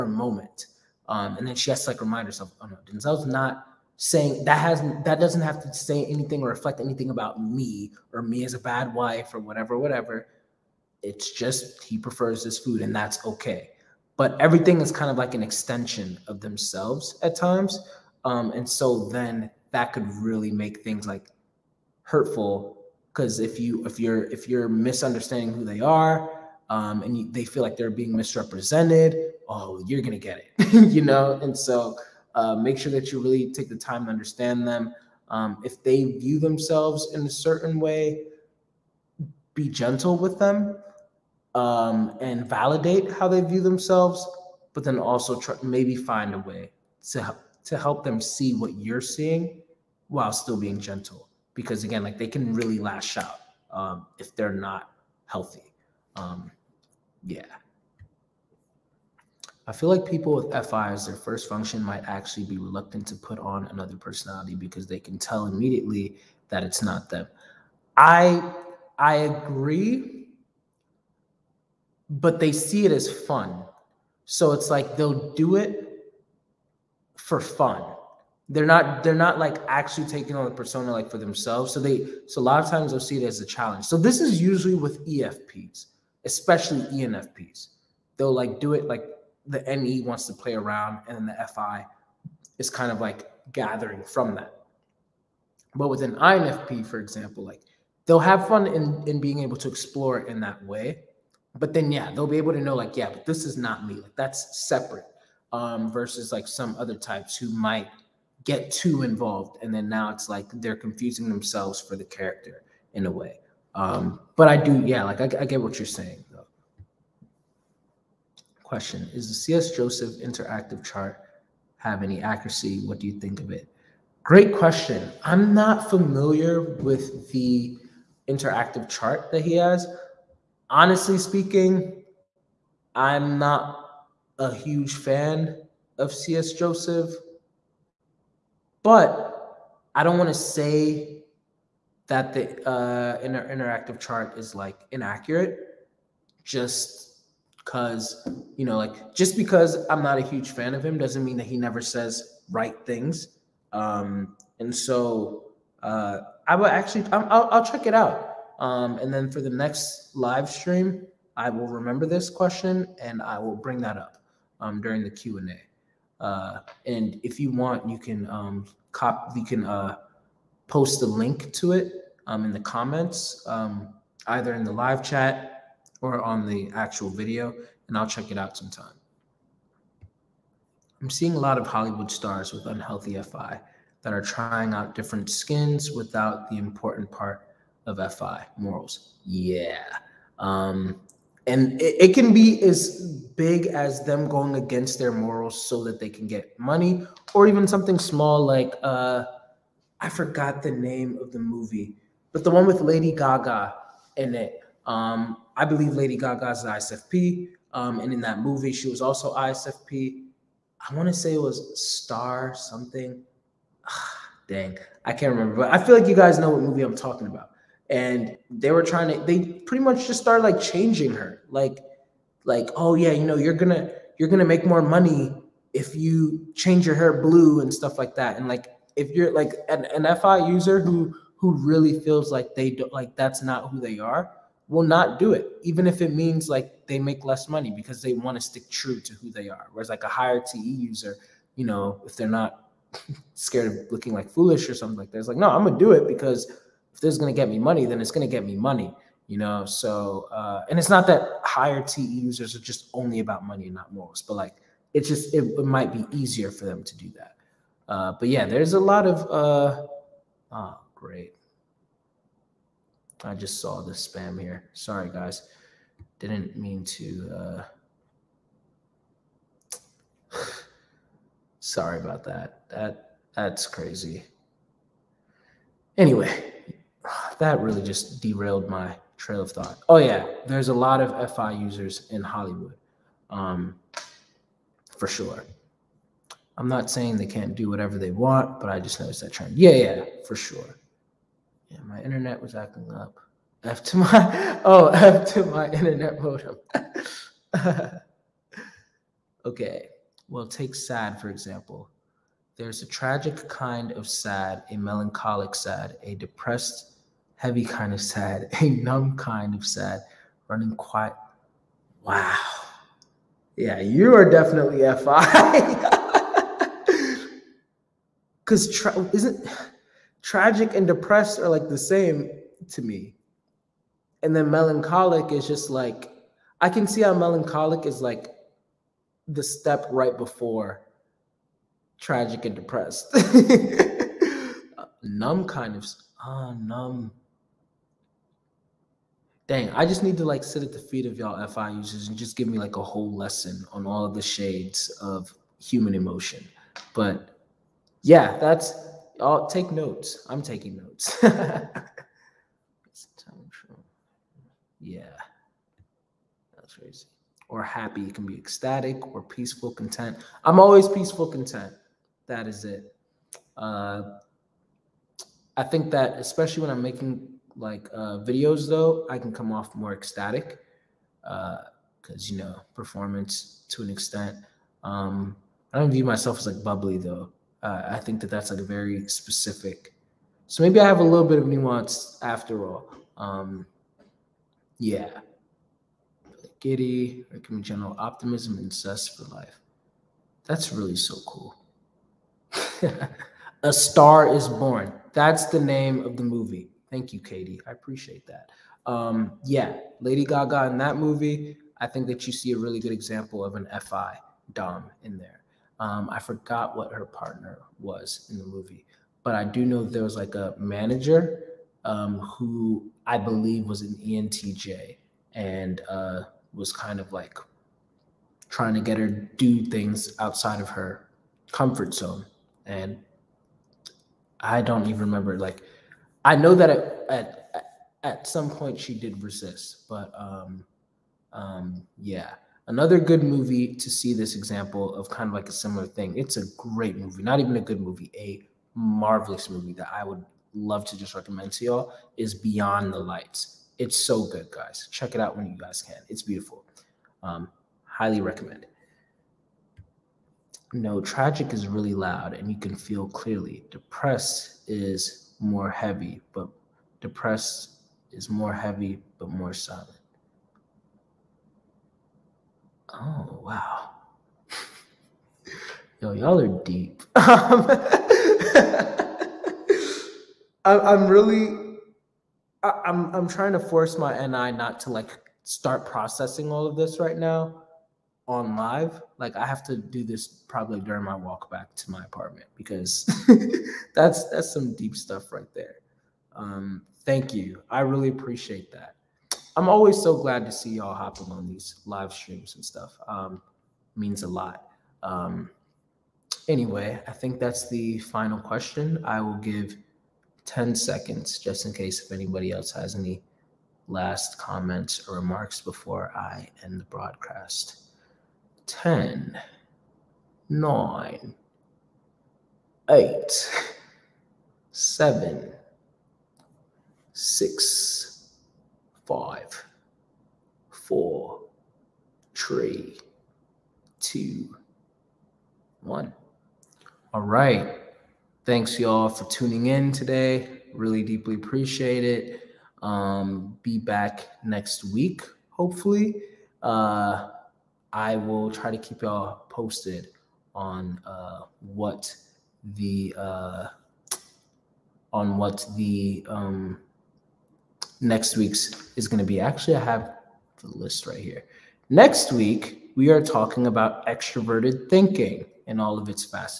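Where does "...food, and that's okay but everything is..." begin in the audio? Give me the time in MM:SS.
00:12.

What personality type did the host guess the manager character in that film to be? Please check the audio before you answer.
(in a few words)
ENTJ.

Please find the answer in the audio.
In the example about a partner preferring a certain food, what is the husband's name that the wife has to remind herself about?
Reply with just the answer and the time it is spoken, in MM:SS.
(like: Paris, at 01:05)
Denzel, at 00:02.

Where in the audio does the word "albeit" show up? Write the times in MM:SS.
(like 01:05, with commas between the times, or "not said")
not said.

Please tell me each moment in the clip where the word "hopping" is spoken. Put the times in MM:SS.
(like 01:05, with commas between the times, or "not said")
08:10.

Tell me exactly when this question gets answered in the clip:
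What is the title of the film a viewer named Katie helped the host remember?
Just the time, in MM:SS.
06:33.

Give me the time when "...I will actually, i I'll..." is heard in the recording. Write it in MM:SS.
02:36.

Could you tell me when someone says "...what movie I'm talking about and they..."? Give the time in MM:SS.
03:36.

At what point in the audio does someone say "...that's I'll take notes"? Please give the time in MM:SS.
05:48.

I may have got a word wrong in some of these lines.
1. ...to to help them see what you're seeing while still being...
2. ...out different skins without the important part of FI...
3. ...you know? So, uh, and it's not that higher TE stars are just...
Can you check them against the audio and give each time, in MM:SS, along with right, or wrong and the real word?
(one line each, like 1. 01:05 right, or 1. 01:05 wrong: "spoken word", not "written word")
1. 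00:47 right
2. 03:04 right
3. 04:09 wrong: "users", not "stars".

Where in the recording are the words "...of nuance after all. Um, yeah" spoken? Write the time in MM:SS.
06:21.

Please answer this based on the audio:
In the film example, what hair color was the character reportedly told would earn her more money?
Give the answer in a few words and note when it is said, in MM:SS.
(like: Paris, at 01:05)
blue, at 03:47.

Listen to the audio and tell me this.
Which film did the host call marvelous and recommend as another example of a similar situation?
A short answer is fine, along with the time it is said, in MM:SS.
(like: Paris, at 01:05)
Beyond the Lights, at 07:22.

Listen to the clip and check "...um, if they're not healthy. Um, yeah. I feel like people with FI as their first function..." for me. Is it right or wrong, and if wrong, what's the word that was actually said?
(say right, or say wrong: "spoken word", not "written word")
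right.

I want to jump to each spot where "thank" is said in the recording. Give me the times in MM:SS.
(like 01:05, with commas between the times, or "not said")
06:36, 08:07, 08:48.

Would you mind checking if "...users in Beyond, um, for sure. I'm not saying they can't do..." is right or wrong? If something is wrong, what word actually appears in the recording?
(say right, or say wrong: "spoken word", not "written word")
wrong: "Hollywood", not "Beyond".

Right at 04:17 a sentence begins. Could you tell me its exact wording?
Uh, but yeah, there's a lot of, uh, oh, great.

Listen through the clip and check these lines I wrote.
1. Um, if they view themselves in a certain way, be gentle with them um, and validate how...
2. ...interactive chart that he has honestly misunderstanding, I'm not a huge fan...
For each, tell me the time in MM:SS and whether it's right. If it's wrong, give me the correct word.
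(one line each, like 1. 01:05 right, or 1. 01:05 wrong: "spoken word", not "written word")
1. 00:35 right
2. 02:08 wrong: "speaking", not "misunderstanding".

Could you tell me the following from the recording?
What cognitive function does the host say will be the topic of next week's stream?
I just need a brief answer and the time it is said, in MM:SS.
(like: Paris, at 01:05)
extroverted thinking, at 09:14.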